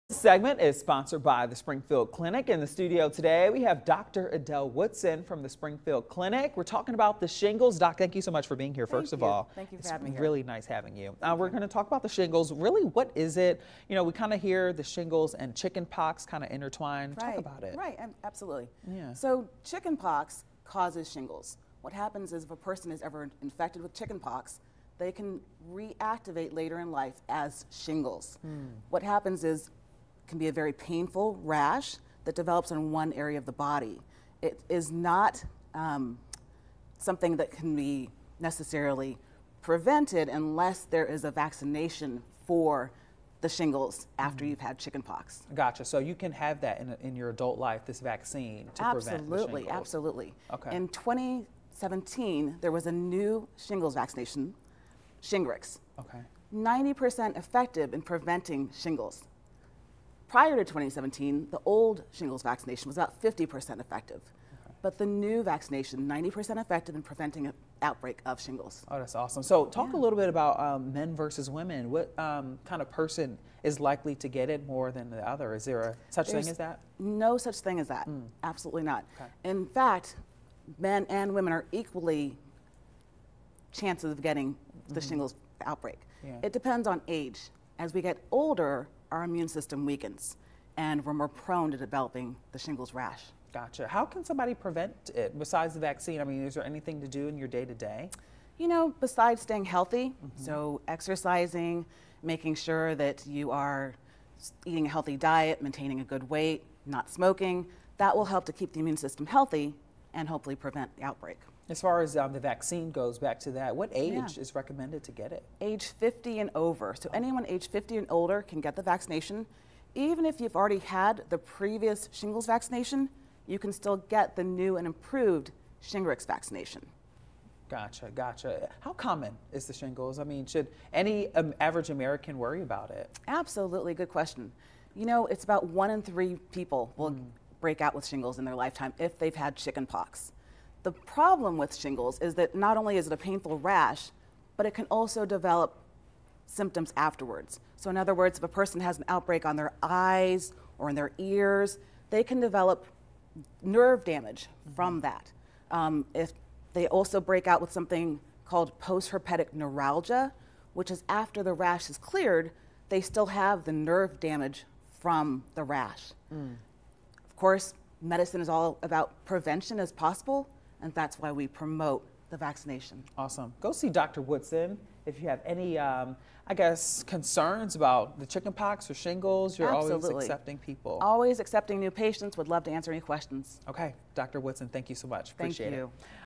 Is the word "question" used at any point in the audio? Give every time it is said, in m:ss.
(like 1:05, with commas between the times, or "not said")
2:14, 3:03.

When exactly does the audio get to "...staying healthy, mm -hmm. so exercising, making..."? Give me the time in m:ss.
1:39.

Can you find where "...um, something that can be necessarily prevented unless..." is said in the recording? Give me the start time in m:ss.
0:35.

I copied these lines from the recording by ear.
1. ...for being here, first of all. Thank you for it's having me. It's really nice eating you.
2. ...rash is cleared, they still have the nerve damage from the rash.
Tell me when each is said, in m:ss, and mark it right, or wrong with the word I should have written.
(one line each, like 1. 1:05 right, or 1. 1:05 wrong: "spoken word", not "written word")
1. 0:08 wrong: "having", not "eating"
2. 2:41 right.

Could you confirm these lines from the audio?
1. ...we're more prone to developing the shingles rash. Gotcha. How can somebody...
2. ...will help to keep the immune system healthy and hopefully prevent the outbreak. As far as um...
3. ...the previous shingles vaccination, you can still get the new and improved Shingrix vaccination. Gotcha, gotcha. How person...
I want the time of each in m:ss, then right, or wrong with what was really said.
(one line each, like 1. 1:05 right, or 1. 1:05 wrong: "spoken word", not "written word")
1. 1:31 right
2. 1:48 right
3. 2:01 wrong: "common", not "person".